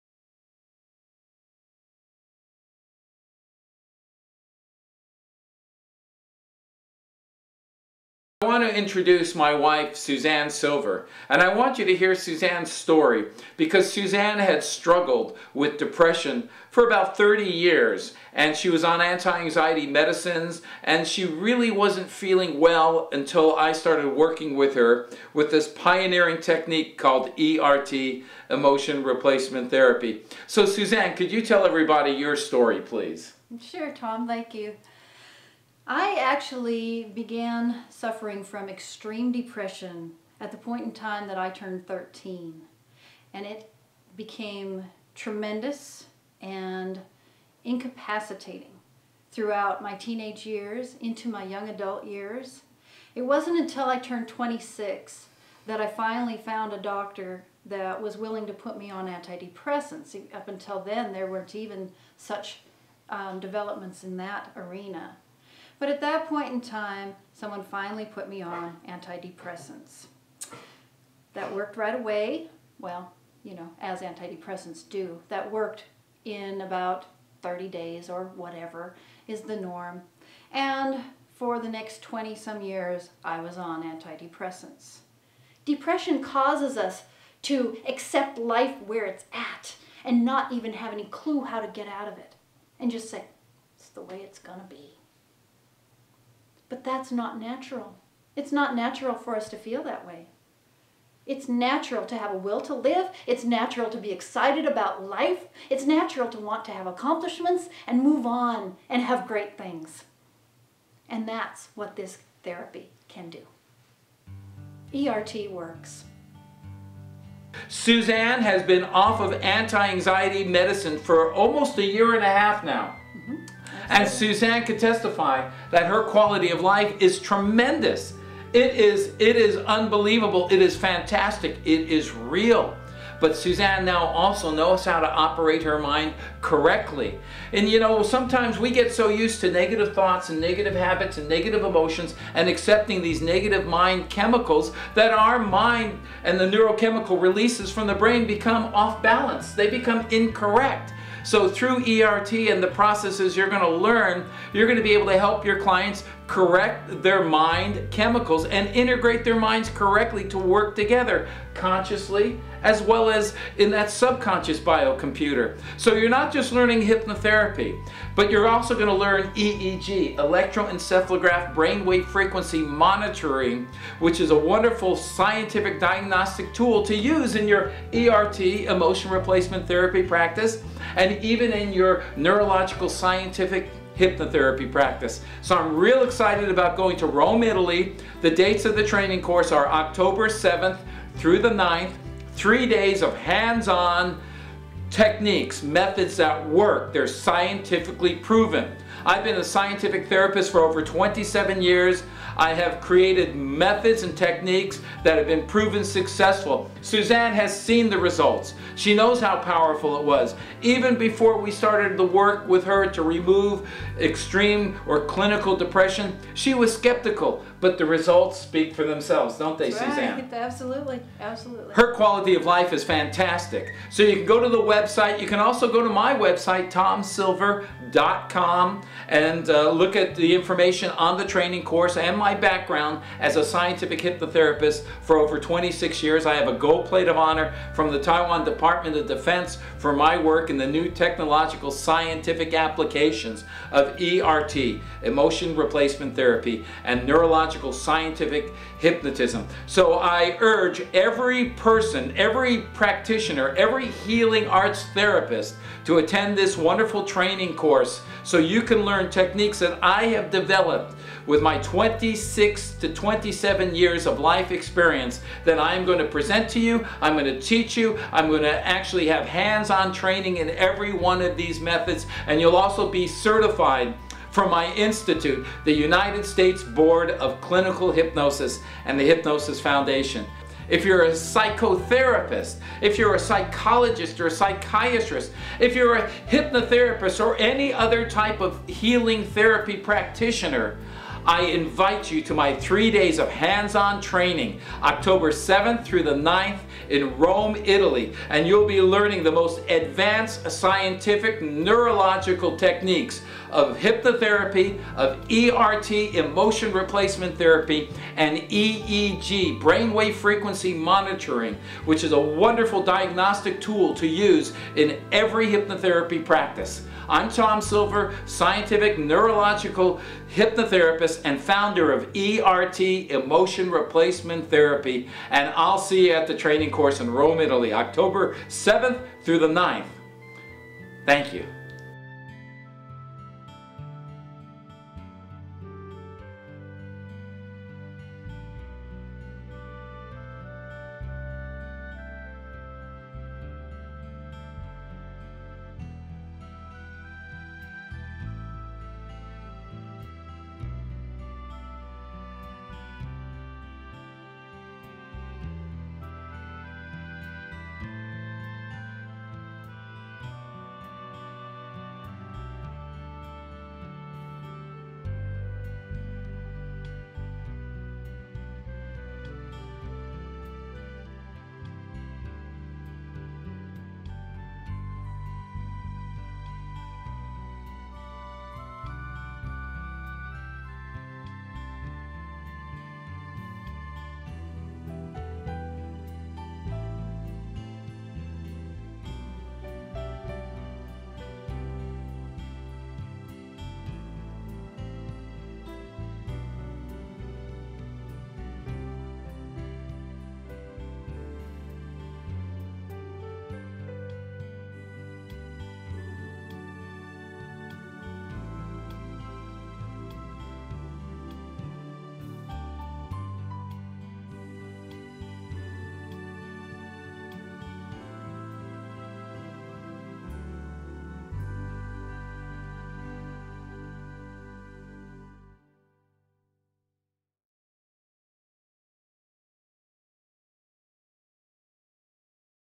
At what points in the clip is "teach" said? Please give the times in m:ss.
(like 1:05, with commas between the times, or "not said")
4:27.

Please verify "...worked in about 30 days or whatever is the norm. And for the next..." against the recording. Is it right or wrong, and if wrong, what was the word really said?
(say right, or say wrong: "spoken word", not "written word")
right.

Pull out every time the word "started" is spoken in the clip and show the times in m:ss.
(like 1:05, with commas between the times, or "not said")
0:23, 3:31.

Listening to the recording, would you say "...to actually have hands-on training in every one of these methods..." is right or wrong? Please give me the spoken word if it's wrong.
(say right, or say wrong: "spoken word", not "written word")
right.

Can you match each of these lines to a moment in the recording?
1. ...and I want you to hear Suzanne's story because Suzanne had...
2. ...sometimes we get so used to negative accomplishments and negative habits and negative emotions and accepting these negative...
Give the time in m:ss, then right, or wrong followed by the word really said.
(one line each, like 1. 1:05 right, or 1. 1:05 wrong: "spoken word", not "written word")
1. 0:11 right
2. 2:18 wrong: "thoughts", not "accomplishments".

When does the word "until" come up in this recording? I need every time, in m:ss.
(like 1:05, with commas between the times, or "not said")
0:23, 0:53, 1:00.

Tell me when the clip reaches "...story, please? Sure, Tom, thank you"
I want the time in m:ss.
0:32.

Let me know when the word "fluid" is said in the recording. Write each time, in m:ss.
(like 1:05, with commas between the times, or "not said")
not said.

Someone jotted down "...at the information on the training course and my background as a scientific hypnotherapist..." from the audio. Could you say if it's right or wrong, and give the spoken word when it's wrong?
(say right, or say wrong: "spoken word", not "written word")
right.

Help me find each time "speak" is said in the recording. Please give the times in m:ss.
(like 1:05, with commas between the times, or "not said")
3:38.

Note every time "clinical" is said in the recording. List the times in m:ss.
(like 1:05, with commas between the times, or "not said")
3:35, 4:37.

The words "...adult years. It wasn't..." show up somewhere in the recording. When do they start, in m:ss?
0:51.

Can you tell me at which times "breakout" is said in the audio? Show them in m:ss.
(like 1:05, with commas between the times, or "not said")
not said.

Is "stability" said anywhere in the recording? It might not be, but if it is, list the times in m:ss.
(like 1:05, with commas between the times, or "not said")
not said.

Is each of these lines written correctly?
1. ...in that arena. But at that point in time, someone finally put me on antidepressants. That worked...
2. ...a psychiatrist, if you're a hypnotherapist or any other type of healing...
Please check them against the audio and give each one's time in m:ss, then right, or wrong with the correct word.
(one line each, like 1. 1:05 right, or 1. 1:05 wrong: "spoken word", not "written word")
1. 1:04 right
2. 4:44 right.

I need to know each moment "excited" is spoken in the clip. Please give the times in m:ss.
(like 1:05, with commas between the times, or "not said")
1:44, 3:06.